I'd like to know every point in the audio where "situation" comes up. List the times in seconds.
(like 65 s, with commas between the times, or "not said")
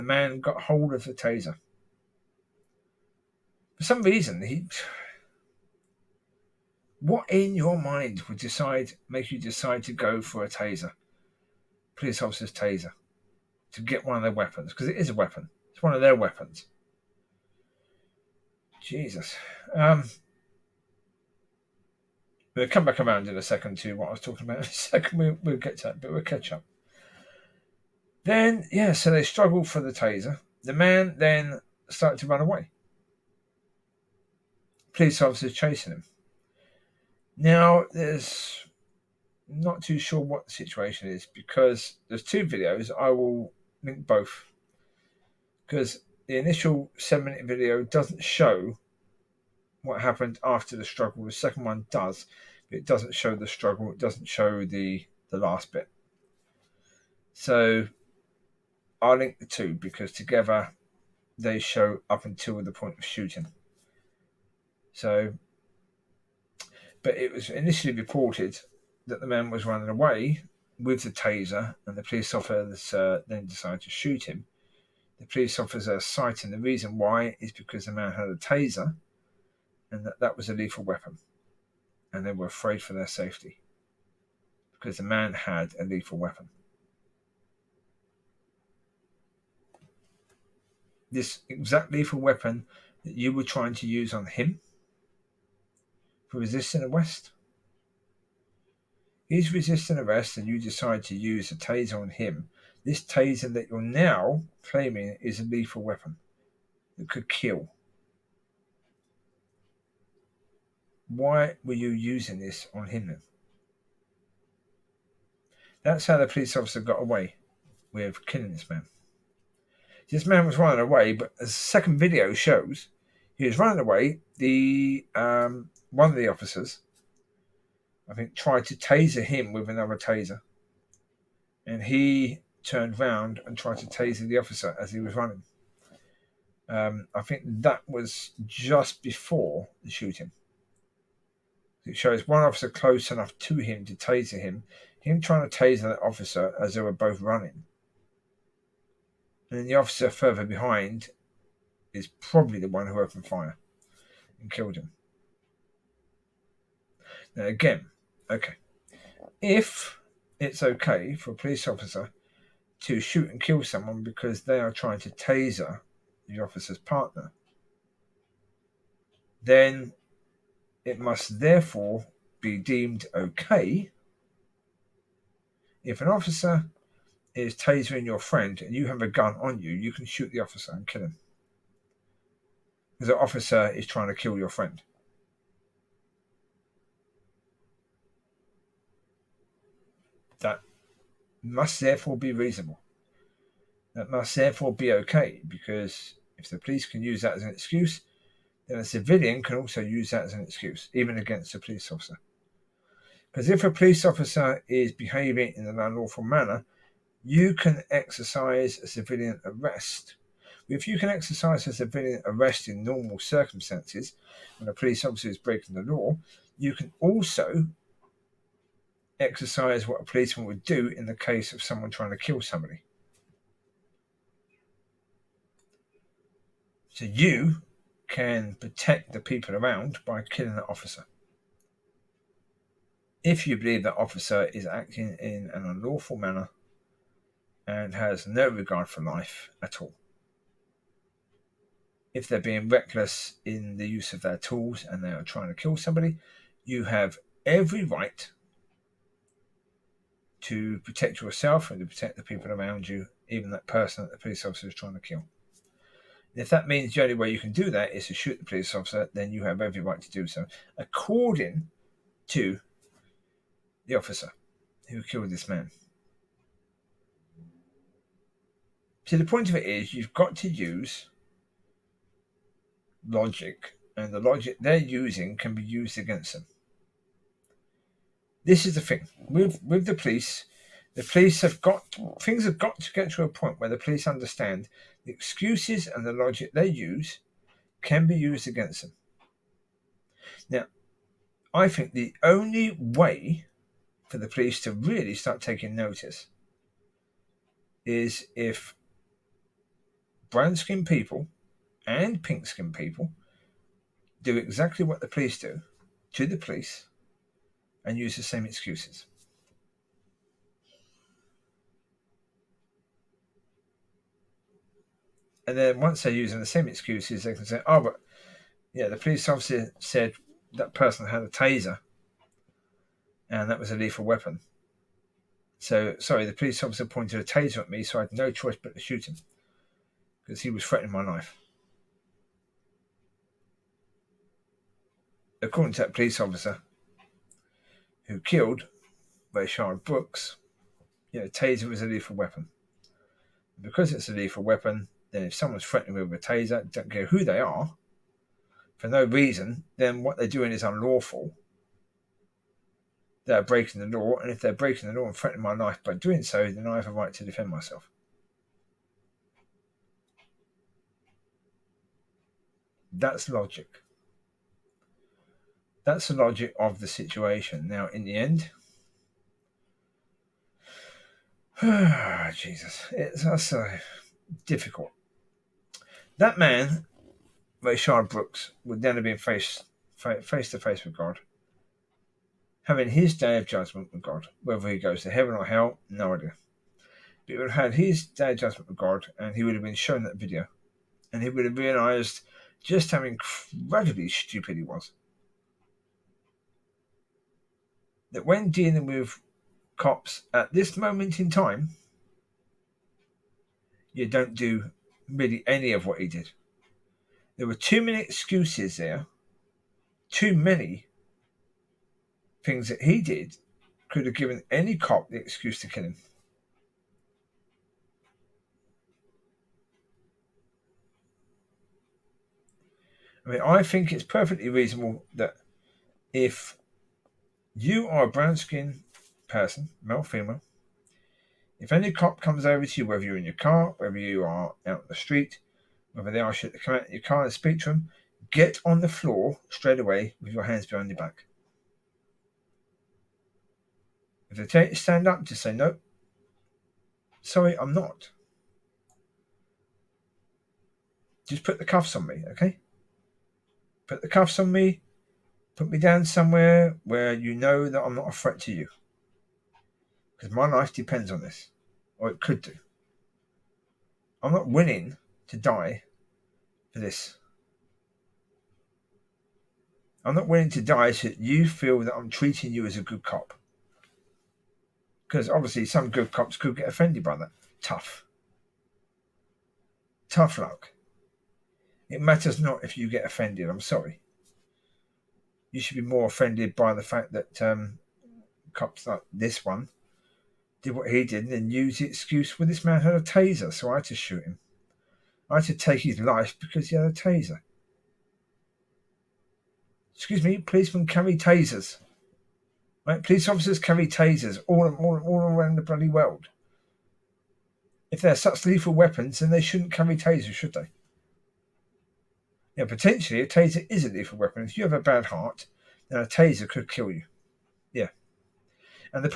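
40 s, 366 s.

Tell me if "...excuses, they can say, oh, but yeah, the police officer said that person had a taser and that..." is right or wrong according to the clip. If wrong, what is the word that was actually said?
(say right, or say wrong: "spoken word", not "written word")
right.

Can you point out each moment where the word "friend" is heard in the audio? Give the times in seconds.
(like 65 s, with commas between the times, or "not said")
178 s, 184 s.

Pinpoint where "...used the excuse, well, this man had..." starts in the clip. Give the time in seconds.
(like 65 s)
491 s.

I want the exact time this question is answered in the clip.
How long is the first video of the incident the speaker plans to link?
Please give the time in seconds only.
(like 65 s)
46 s.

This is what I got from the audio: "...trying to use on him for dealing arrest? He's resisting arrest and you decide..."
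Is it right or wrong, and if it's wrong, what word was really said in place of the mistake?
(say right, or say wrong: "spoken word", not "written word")
wrong: "resisting", not "dealing".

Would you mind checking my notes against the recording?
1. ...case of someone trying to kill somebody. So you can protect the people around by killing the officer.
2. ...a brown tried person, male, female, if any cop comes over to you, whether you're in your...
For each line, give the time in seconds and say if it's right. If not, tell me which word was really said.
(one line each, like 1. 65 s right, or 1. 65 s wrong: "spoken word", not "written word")
1. 221 s right
2. 428 s wrong: "skinned", not "tried".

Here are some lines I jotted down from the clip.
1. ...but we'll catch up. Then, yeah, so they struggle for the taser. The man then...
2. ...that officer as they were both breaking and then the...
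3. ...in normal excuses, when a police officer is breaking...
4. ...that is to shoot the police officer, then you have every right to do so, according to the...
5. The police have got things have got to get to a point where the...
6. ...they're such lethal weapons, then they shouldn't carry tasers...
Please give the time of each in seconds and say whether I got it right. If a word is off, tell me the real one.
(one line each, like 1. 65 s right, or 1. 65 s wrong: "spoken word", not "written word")
1. 26 s right
2. 145 s wrong: "running", not "breaking"
3. 212 s wrong: "circumstances", not "excuses"
4. 257 s right
5. 280 s right
6. 508 s right.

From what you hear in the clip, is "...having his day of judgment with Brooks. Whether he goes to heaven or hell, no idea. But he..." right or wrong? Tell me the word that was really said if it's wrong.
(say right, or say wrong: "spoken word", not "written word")
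wrong: "God", not "Brooks".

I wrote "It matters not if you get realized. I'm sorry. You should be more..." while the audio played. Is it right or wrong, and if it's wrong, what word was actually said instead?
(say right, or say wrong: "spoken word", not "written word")
wrong: "offended", not "realized".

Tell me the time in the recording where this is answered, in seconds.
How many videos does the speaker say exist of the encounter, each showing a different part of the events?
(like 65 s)
42 s.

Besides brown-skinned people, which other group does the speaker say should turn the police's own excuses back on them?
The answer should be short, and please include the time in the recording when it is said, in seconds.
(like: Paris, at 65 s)
pink skinned people, at 302 s.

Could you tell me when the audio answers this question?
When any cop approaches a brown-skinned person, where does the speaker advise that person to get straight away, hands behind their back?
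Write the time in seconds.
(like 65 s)
438 s.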